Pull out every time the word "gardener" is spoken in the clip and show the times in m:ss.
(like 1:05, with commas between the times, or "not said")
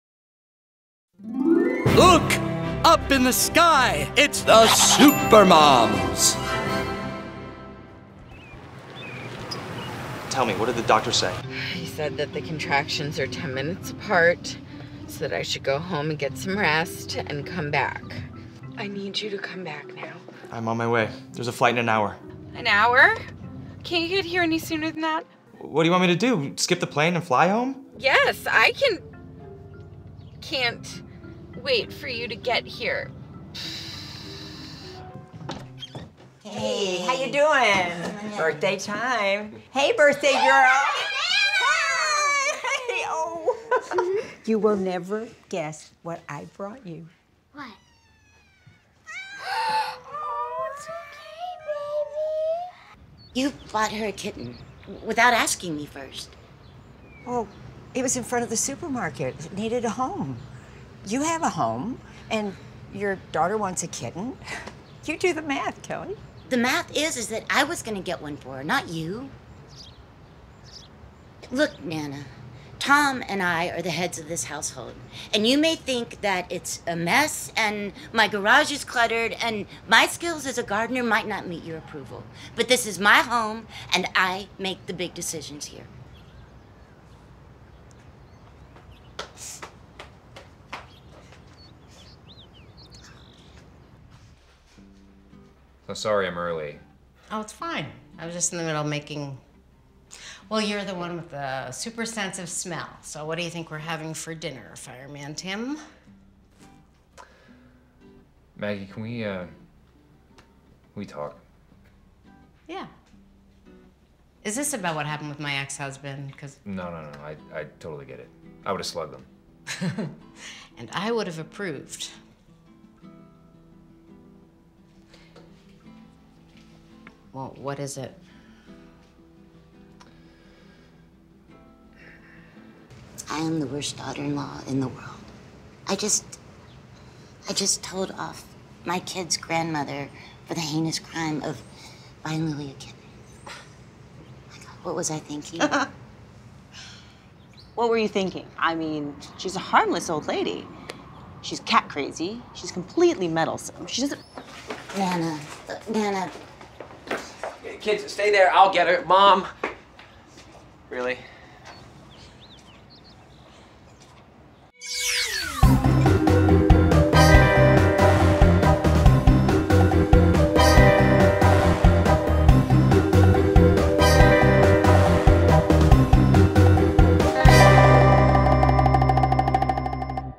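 1:20.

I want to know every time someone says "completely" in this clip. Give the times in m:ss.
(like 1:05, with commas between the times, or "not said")
2:32.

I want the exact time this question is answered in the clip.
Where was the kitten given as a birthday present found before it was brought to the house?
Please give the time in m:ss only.
0:58.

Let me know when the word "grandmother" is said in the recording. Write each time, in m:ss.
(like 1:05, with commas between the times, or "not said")
2:19.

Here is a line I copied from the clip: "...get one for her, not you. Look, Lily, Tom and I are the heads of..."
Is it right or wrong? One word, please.
wrong.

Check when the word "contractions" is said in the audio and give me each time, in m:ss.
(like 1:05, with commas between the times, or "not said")
0:12.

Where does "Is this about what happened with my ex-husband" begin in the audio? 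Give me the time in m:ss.
1:54.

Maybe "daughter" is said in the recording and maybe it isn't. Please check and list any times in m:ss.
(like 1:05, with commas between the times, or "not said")
1:03, 2:13.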